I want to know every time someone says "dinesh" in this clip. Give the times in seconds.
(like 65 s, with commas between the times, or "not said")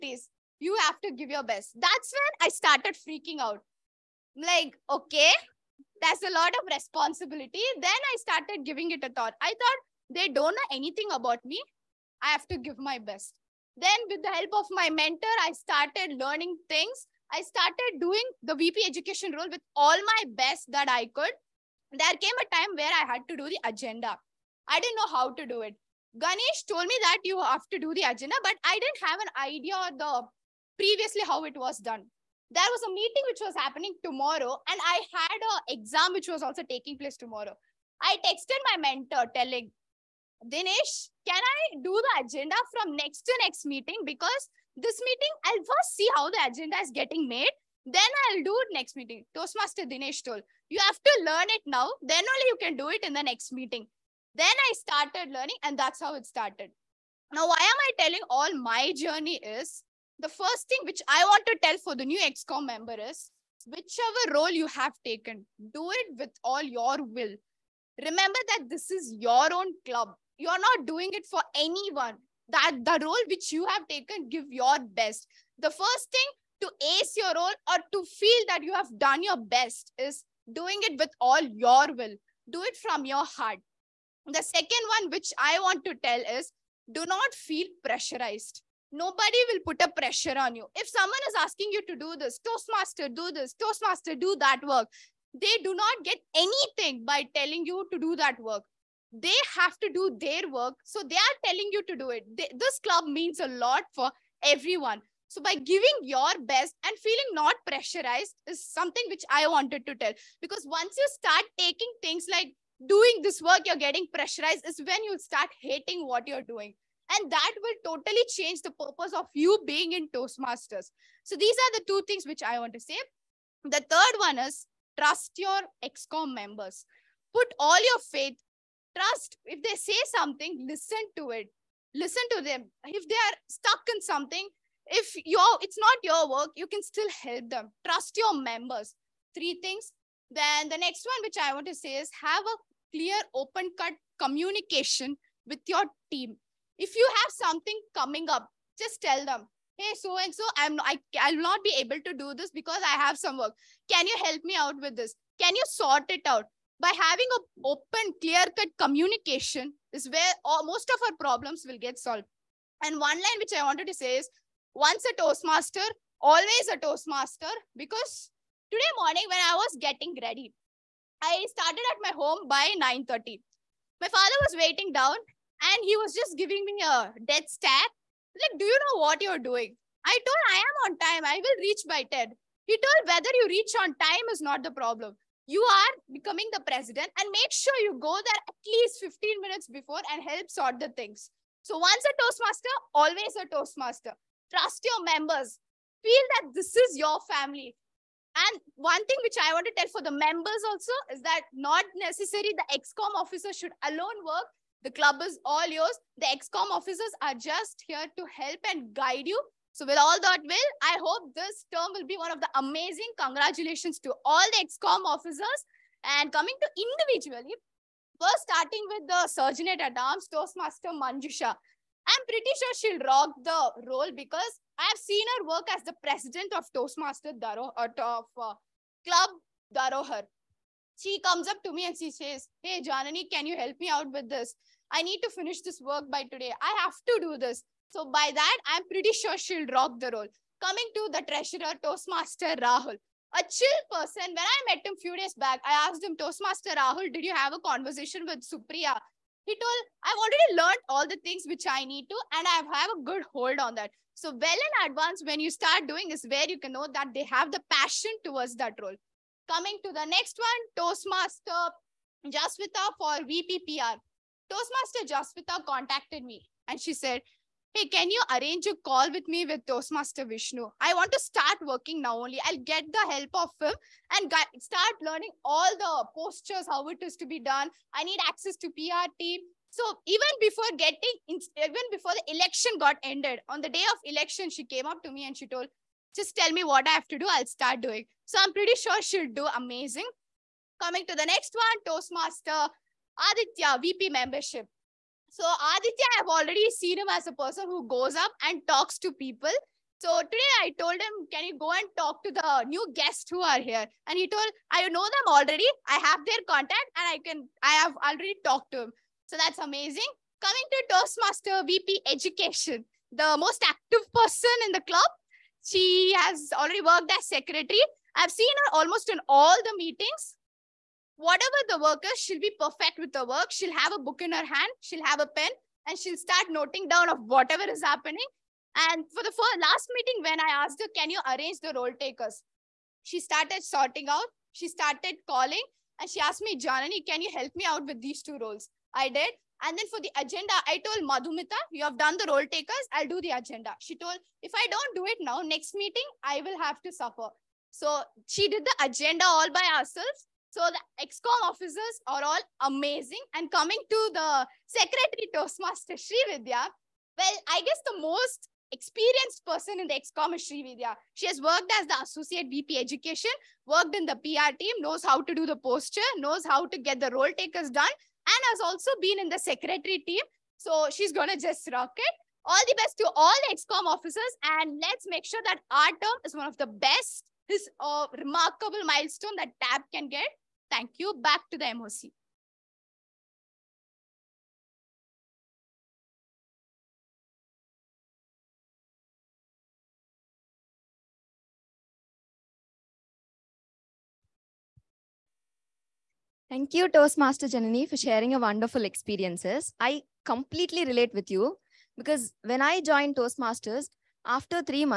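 40 s, 49 s.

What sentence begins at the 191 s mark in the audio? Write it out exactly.
So once a Toastmaster, always a Toastmaster.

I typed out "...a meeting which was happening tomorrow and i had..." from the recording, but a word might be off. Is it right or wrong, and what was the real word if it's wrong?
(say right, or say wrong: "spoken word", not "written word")
right.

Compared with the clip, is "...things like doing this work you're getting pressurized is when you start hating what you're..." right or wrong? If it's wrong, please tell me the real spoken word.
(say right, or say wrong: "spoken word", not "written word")
right.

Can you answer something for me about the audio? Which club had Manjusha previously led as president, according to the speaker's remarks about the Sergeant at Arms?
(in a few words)
Club Darohar.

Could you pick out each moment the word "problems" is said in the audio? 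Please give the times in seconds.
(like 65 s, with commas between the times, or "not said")
161 s, 184 s.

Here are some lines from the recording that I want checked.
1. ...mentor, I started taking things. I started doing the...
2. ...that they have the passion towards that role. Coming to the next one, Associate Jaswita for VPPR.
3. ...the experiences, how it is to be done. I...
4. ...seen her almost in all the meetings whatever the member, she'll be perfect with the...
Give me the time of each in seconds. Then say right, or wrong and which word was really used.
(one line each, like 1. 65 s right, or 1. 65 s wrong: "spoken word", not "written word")
1. 14 s wrong: "learning", not "taking"
2. 256 s wrong: "Toastmaster", not "Associate"
3. 275 s wrong: "postures", not "experiences"
4. 318 s wrong: "worker", not "member".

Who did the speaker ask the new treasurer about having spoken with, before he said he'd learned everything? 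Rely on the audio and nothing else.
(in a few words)
Supriya.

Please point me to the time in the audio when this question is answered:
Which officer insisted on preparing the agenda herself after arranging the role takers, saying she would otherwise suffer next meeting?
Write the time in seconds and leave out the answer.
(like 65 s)
341 s.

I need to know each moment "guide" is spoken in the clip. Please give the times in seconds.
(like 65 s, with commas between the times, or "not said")
208 s.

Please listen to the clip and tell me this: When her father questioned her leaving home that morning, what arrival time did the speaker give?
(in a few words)
10.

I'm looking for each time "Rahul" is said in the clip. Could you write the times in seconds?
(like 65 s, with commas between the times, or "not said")
242 s, 246 s.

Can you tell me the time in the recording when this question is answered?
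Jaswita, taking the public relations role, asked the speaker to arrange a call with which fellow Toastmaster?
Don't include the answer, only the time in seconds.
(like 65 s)
270 s.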